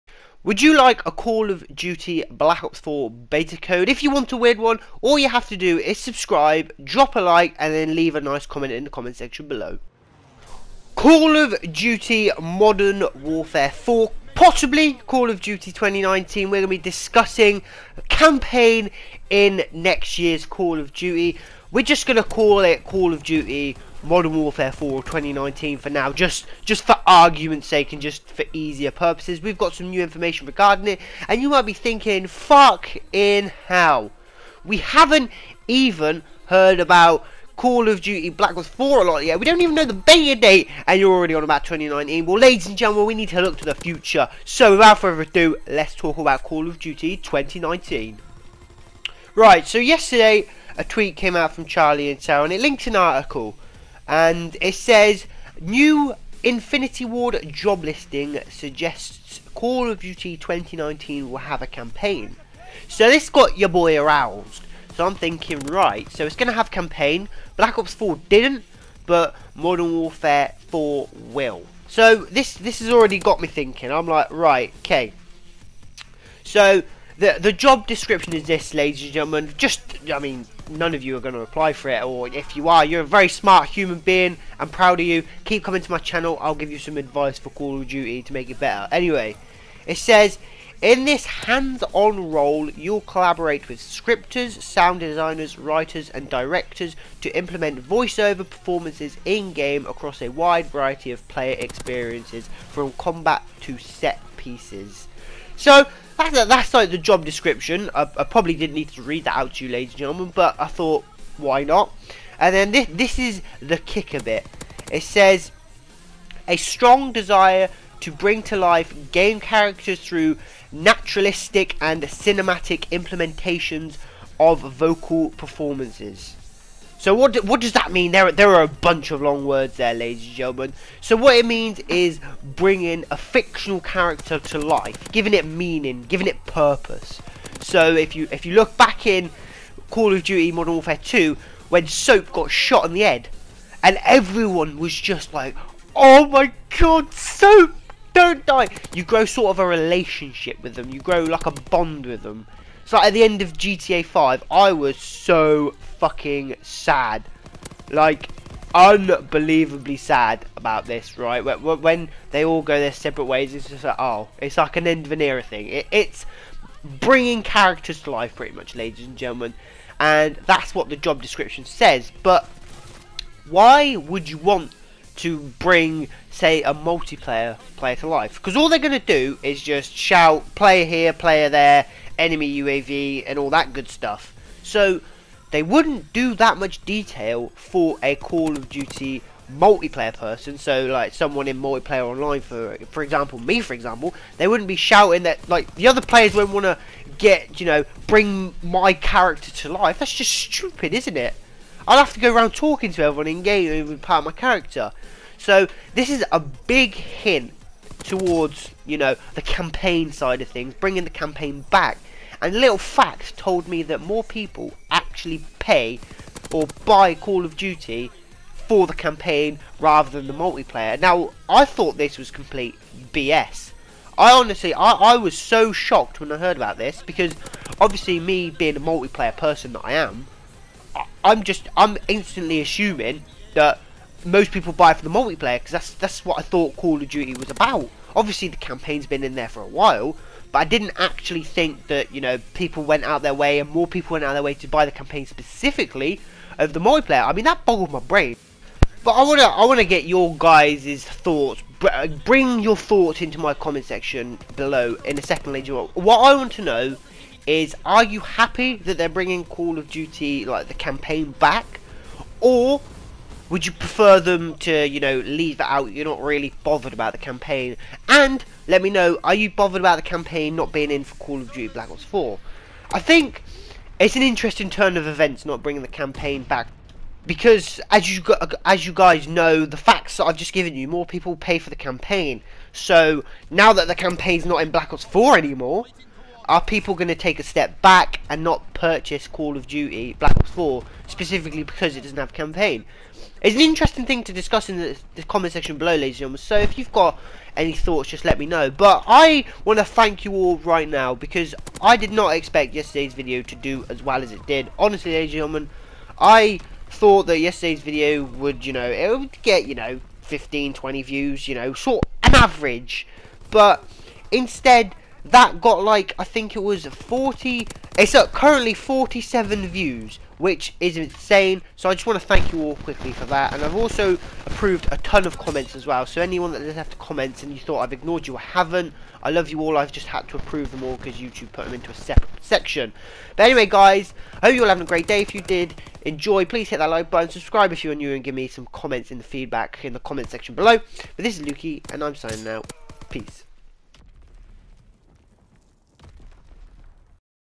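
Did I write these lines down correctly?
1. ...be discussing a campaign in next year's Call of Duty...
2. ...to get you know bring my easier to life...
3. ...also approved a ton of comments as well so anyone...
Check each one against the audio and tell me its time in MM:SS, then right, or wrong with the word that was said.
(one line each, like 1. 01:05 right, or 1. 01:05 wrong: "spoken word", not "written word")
1. 00:16 right
2. 03:16 wrong: "character", not "easier"
3. 05:23 right.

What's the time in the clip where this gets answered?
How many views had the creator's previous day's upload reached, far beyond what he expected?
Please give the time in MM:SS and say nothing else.
05:18.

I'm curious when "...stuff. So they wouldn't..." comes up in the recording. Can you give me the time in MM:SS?
03:03.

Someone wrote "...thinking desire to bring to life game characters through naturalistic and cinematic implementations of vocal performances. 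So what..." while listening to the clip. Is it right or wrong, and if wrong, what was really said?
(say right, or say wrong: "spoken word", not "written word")
wrong: "strong", not "thinking".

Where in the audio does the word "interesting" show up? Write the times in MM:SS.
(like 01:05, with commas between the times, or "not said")
04:34, 04:53.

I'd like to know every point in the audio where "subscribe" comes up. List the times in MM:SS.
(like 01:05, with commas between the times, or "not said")
00:05, 05:37.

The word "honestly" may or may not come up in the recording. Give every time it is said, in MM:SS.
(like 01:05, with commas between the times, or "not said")
03:44, 05:04.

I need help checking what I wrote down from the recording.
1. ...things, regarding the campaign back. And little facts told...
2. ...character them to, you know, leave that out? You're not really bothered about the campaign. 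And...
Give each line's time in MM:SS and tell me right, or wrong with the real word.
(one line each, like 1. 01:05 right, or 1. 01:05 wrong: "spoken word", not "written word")
1. 03:30 wrong: "bringing", not "regarding"
2. 04:23 wrong: "prefer", not "character".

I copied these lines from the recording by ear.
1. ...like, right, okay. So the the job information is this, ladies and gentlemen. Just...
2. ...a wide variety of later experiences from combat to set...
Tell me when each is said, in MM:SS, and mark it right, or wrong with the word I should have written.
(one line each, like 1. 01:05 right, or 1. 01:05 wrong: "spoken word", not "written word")
1. 01:14 wrong: "description", not "information"
2. 01:40 wrong: "player", not "later".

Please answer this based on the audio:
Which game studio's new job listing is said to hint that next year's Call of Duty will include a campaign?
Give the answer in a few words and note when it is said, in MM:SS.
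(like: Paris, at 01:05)
Infinity Ward, at 00:56.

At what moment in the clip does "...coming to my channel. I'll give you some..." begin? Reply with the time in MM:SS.
01:25.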